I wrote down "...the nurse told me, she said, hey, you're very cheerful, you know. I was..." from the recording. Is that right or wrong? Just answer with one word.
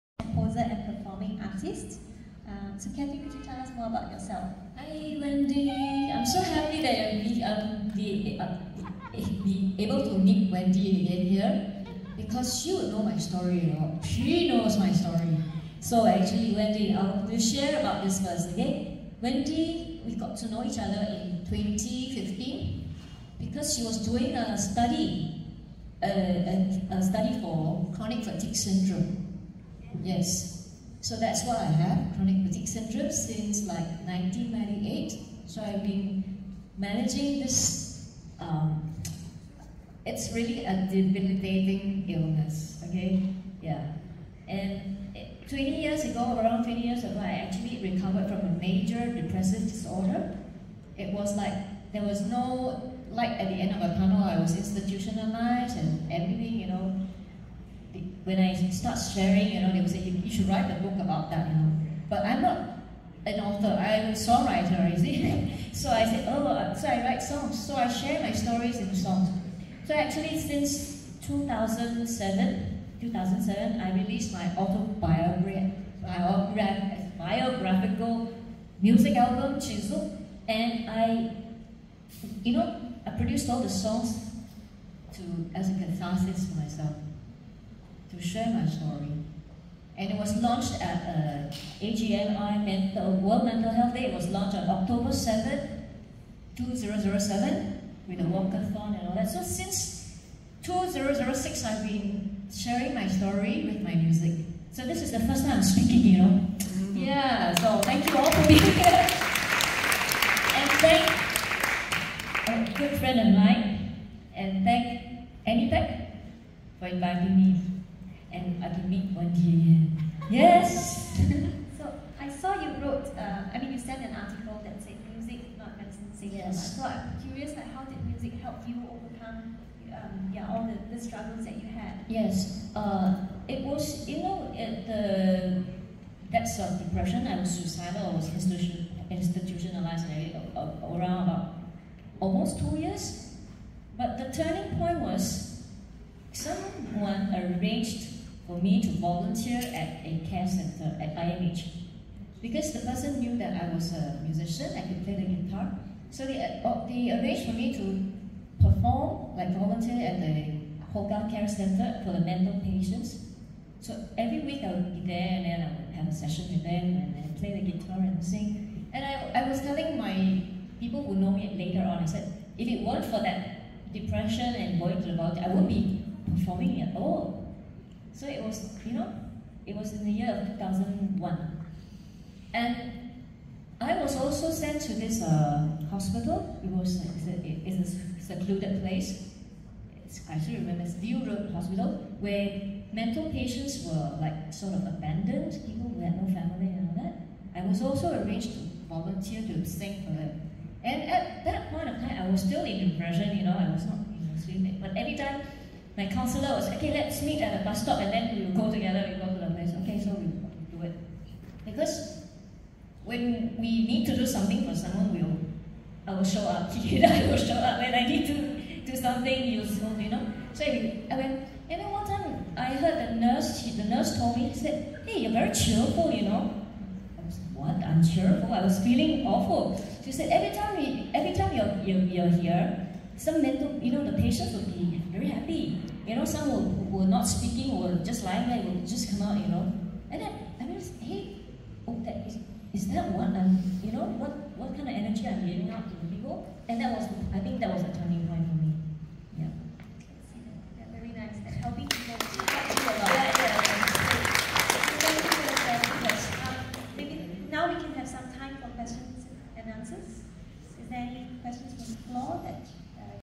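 right.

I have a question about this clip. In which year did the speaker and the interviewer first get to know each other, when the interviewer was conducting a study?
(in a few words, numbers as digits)
2015.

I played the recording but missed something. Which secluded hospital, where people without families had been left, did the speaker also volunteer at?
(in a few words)
View Road Hospital.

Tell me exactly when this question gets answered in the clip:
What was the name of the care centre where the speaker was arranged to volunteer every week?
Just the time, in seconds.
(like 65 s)
160 s.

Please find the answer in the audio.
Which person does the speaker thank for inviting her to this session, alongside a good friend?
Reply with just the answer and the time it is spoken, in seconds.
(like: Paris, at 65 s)
Annie Beck, at 115 s.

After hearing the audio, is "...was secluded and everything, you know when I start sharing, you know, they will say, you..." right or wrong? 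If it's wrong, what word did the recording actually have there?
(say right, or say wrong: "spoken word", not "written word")
wrong: "institutionalized", not "secluded".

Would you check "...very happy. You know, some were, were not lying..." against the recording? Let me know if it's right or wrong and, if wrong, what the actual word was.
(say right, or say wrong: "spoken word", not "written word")
wrong: "speaking", not "lying".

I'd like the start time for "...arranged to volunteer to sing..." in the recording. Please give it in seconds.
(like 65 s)
198 s.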